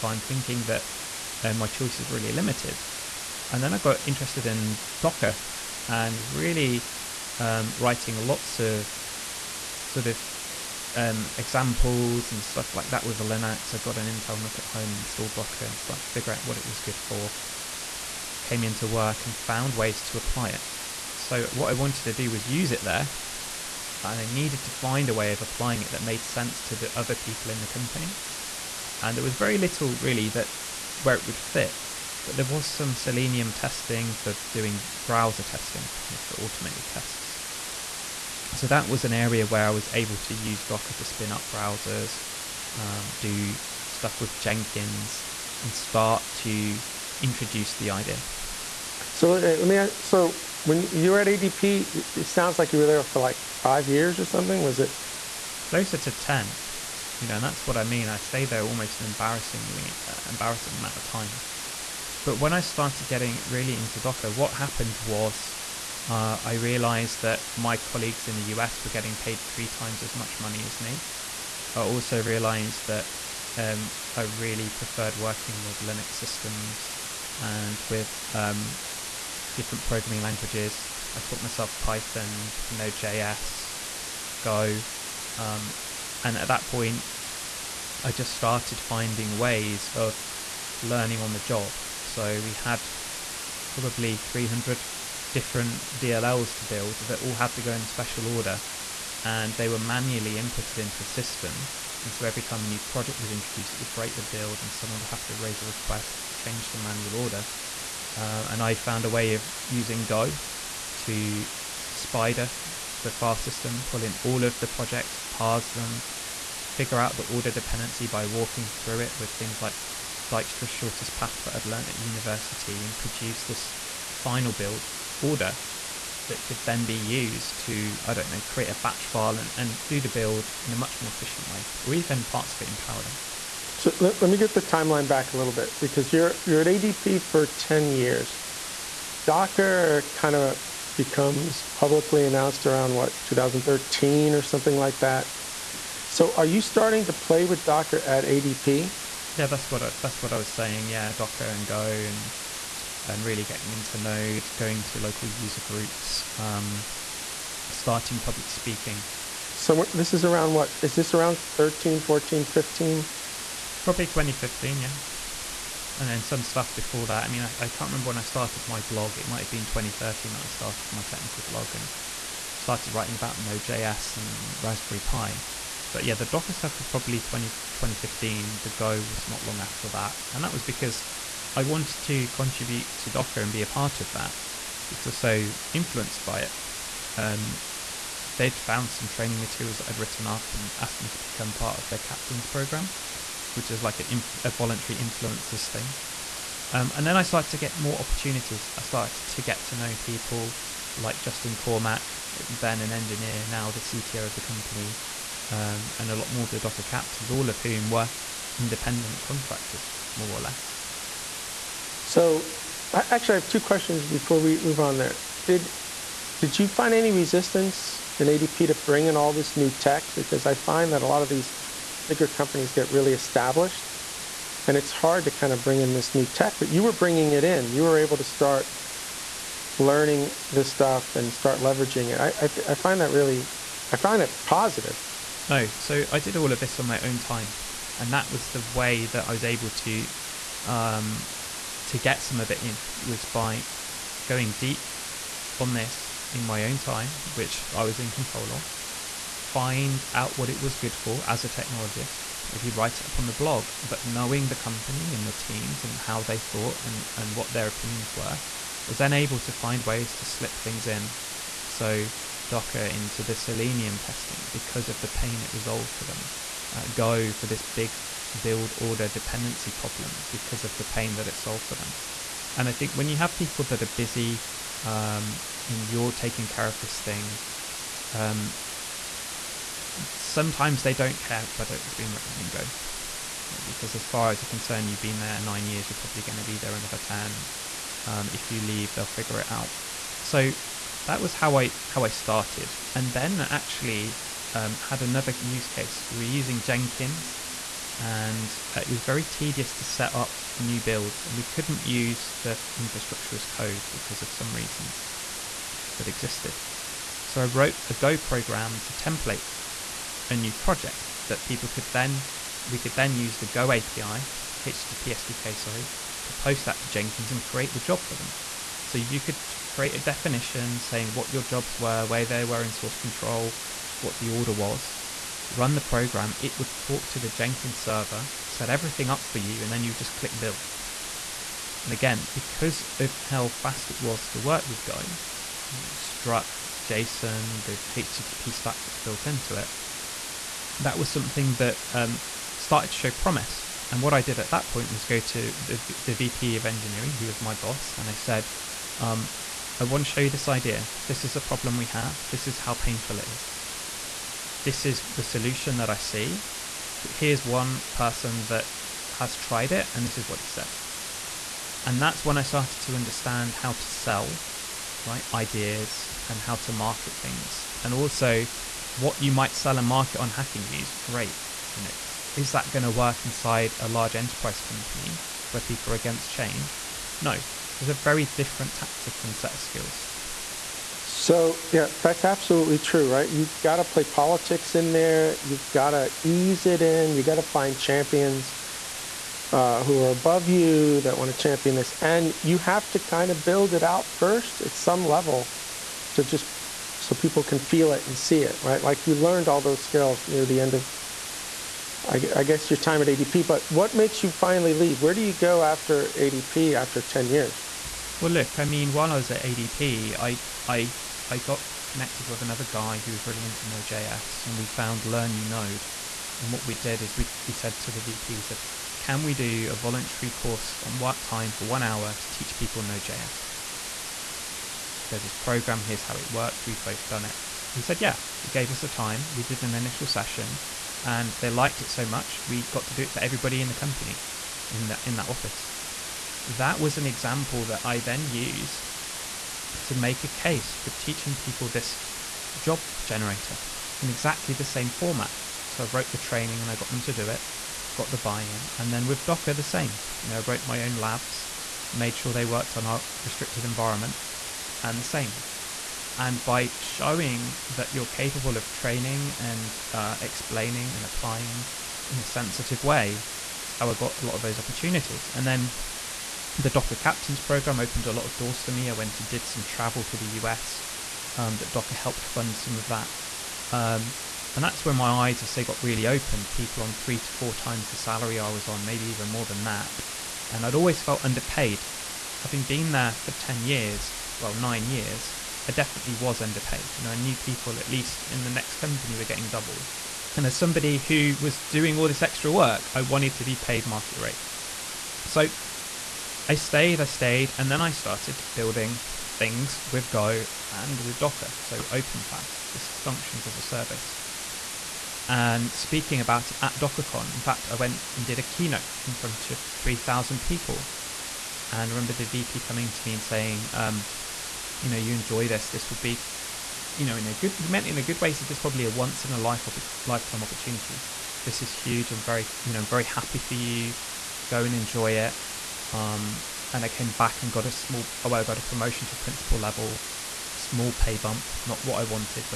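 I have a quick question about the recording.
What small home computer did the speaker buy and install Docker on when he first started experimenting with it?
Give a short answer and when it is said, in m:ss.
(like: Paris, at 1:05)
Intel NUC, at 0:14.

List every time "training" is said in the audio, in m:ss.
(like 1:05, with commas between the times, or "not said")
3:09, 7:26, 7:38.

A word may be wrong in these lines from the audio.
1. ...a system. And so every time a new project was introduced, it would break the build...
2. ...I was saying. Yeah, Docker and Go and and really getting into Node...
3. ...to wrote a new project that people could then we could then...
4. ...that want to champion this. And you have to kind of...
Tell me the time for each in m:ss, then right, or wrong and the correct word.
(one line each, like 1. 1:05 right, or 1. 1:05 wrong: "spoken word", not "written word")
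1. 1:41 right
2. 2:30 right
3. 5:08 wrong: "template", not "wrote"
4. 6:30 right.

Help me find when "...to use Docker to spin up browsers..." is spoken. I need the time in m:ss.
0:40.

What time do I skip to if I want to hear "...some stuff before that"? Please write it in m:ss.
2:46.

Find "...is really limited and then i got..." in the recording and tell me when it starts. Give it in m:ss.
0:01.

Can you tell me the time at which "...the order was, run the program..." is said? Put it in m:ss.
5:24.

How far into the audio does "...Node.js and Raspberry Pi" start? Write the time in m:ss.
2:53.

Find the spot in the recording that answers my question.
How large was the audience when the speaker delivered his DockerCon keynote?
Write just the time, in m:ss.
8:29.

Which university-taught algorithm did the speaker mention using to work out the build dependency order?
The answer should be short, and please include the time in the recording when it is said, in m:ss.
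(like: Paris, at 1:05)
Dijkstra's shortest path, at 2:00.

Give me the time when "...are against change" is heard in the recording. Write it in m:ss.
6:15.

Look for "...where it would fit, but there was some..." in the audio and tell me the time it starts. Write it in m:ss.
0:31.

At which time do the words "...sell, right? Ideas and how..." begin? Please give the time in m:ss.
6:03.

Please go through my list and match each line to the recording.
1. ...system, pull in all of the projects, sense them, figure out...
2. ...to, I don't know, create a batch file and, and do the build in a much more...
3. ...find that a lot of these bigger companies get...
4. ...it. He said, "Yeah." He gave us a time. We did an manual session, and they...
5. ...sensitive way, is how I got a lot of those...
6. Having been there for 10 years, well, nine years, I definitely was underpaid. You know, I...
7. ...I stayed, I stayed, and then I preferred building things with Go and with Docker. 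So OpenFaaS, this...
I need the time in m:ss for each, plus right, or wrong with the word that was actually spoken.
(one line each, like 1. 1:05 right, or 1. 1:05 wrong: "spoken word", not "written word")
1. 1:53 wrong: "parse", not "sense"
2. 2:07 right
3. 3:40 right
4. 7:07 wrong: "initial", not "manual"
5. 7:42 right
6. 8:02 right
7. 8:16 wrong: "started", not "preferred".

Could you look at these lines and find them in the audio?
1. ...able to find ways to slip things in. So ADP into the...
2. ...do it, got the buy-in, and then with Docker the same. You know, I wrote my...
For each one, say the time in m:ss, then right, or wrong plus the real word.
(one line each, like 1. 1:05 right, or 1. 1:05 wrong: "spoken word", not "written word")
1. 4:19 wrong: "Docker", not "ADP"
2. 7:27 right.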